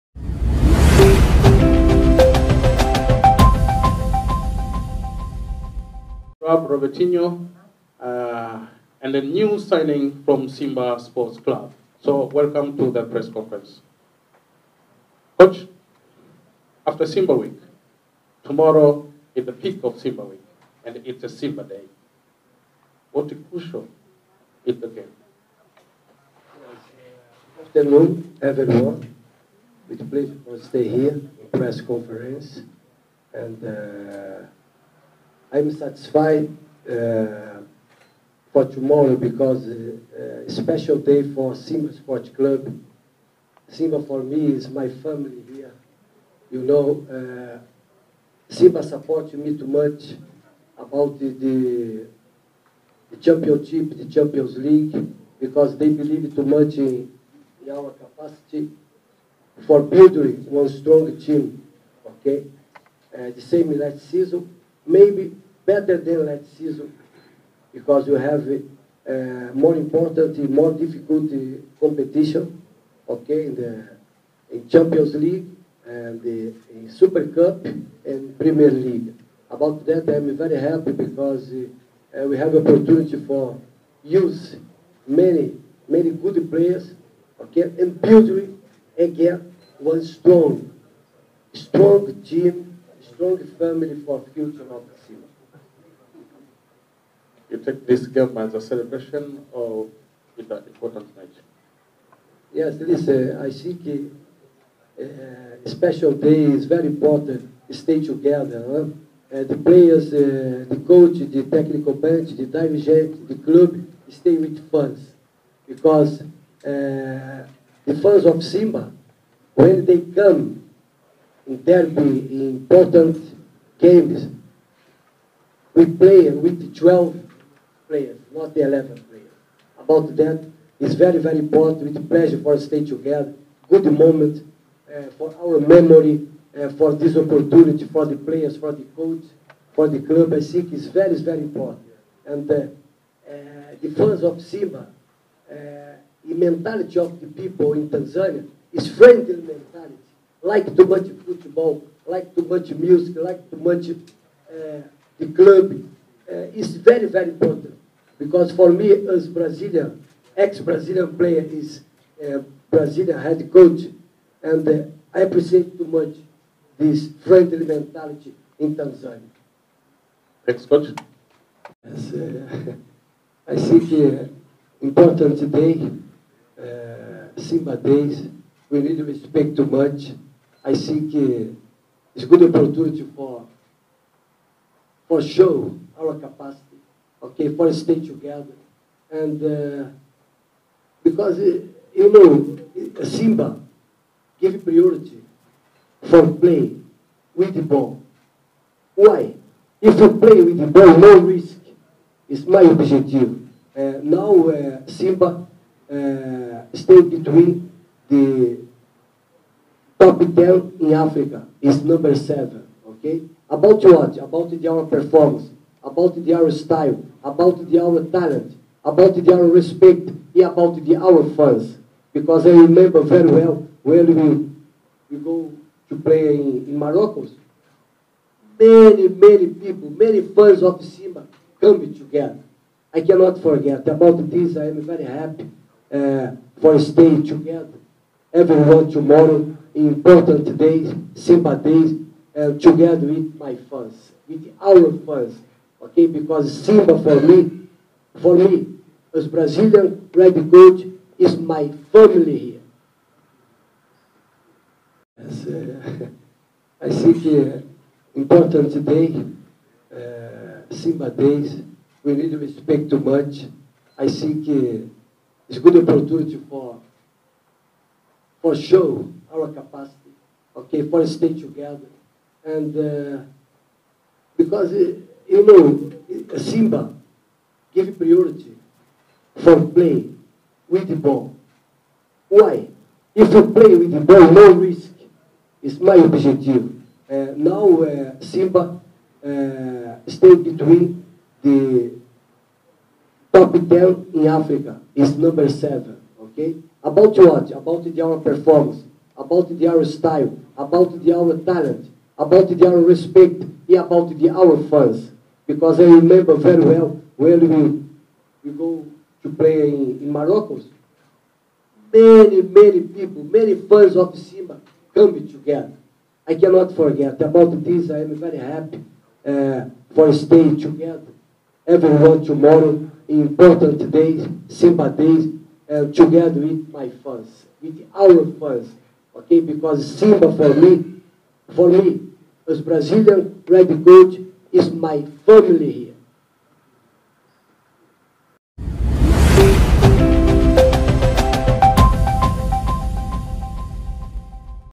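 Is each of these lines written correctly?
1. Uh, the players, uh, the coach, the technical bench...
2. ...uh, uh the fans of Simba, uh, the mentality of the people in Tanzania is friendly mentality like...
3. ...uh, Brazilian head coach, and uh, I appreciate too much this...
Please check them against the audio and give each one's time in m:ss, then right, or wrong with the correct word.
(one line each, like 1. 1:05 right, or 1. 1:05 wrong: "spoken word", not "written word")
1. 1:49 right
2. 2:22 right
3. 2:42 right.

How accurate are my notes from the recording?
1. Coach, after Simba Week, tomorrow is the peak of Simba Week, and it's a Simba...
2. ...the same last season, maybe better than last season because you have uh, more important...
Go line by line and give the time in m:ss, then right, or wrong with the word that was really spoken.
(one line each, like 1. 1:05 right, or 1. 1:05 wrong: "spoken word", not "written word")
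1. 0:15 right
2. 1:03 right.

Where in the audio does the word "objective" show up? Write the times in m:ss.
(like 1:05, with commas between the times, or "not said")
3:22, 4:45.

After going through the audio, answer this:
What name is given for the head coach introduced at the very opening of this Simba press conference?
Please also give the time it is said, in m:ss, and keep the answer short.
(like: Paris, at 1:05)
Rob Robertinho, at 0:06.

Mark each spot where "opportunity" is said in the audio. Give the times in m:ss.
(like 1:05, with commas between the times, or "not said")
1:22, 2:17, 3:02, 4:25.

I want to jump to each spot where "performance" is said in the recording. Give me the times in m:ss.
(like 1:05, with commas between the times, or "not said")
3:34, 4:58.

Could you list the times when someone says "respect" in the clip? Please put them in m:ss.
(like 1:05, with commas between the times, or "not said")
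2:59, 3:39, 4:22, 5:02.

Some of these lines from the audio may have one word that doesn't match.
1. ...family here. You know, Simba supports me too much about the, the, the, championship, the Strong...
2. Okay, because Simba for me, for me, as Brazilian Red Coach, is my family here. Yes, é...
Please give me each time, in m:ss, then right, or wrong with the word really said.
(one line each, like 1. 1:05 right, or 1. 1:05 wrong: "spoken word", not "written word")
1. 0:44 wrong: "Champions", not "Strong"
2. 4:05 right.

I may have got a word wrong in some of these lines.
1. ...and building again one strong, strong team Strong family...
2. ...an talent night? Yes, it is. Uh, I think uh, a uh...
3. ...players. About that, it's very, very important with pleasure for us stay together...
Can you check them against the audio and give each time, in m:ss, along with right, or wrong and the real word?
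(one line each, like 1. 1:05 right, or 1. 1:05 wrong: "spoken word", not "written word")
1. 1:27 right
2. 1:40 wrong: "important", not "talent"
3. 2:09 right.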